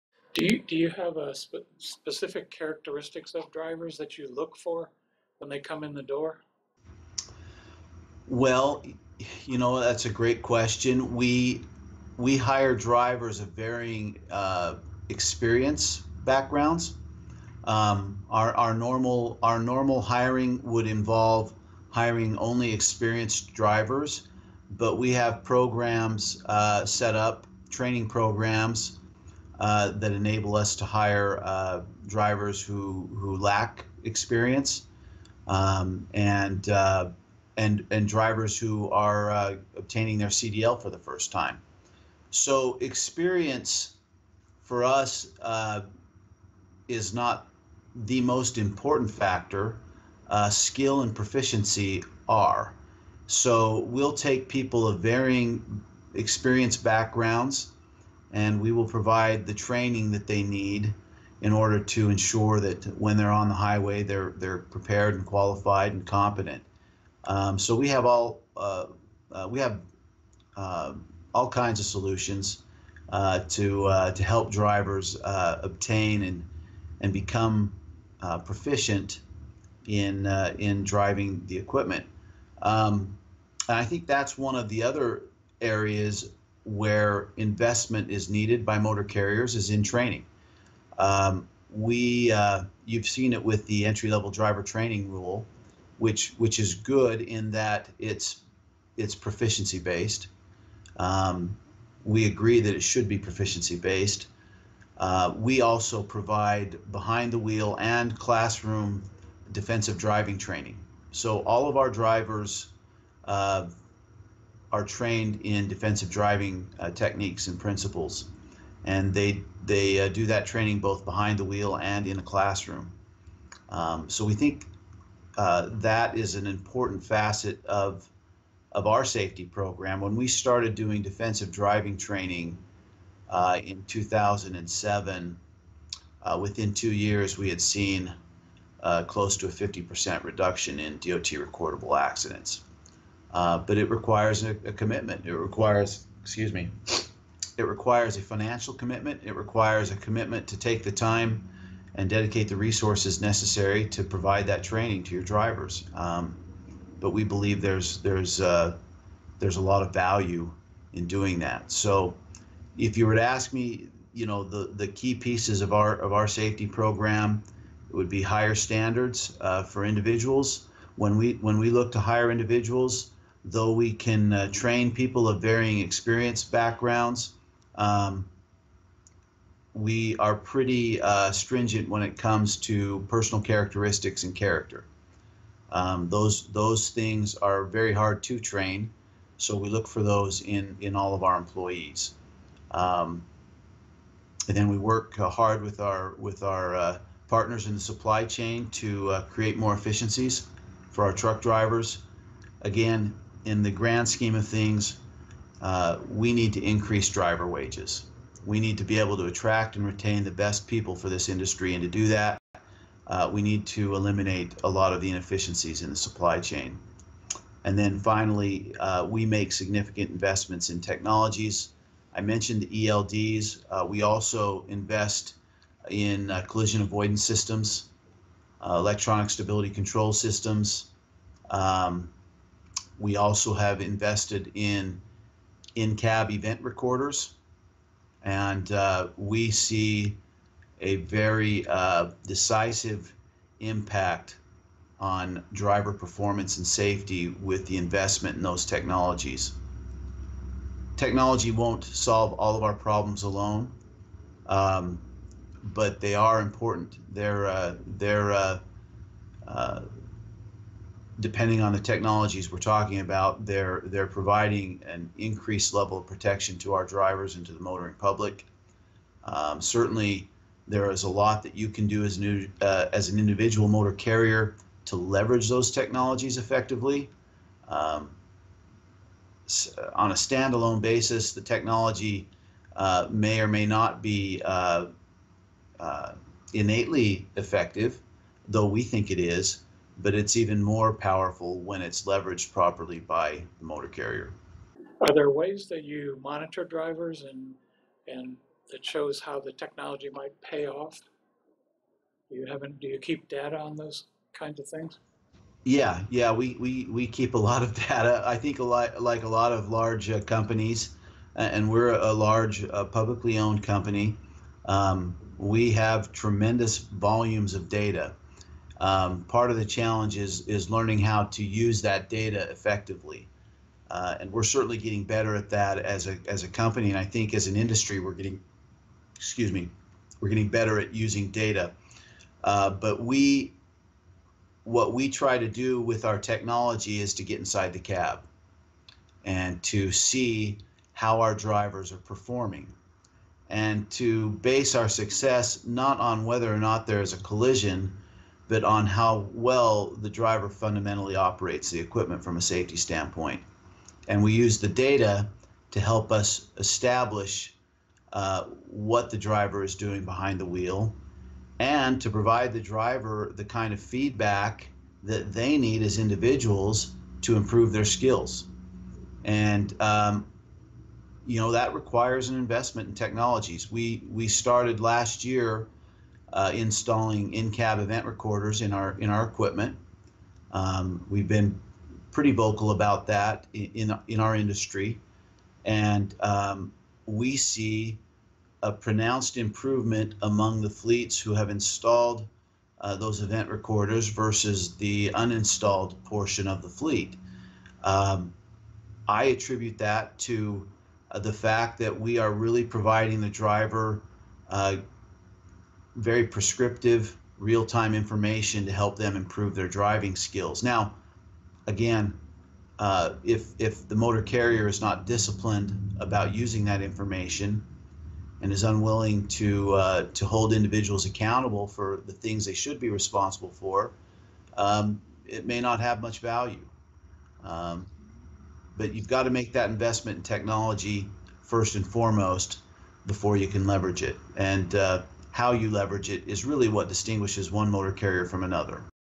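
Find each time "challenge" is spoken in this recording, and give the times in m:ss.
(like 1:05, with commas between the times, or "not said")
5:19.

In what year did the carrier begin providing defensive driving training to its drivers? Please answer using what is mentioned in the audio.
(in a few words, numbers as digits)
2007.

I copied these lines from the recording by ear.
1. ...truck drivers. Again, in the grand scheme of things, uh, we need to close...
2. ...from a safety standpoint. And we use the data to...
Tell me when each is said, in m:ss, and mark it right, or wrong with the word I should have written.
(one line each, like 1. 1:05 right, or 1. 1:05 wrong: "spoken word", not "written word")
1. 3:21 wrong: "increase", not "close"
2. 5:52 right.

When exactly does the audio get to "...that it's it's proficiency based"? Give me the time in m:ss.
1:37.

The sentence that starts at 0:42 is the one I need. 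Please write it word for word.
So experience for us uh, is not the most important factor.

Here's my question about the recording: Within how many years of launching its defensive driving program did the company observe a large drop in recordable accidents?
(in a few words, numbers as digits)
2.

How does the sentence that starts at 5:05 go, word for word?
Yeah, yeah, we, we, we keep a lot of data.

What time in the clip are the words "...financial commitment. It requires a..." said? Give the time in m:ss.
2:28.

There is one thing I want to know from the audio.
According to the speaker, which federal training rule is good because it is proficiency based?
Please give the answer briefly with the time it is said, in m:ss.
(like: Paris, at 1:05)
entry-level driver training rule, at 1:33.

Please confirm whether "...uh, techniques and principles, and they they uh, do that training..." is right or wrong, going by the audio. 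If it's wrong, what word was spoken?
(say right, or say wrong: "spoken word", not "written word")
right.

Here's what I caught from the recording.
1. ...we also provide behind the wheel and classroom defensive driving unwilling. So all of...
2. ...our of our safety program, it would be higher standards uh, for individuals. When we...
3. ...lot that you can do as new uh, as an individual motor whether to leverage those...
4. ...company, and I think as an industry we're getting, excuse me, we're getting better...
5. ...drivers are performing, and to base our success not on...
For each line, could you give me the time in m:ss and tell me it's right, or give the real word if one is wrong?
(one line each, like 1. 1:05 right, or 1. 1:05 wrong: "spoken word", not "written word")
1. 1:45 wrong: "training", not "unwilling"
2. 2:45 right
3. 4:31 wrong: "carrier", not "whether"
4. 5:26 right
5. 5:41 right.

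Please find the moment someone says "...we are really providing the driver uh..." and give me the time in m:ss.
6:41.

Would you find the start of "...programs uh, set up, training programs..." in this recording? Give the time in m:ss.
0:25.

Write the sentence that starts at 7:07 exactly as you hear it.
Um, but you've got to make that investment in technology first and foremost before you can leverage it.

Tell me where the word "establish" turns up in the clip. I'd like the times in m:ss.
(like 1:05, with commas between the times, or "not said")
5:56.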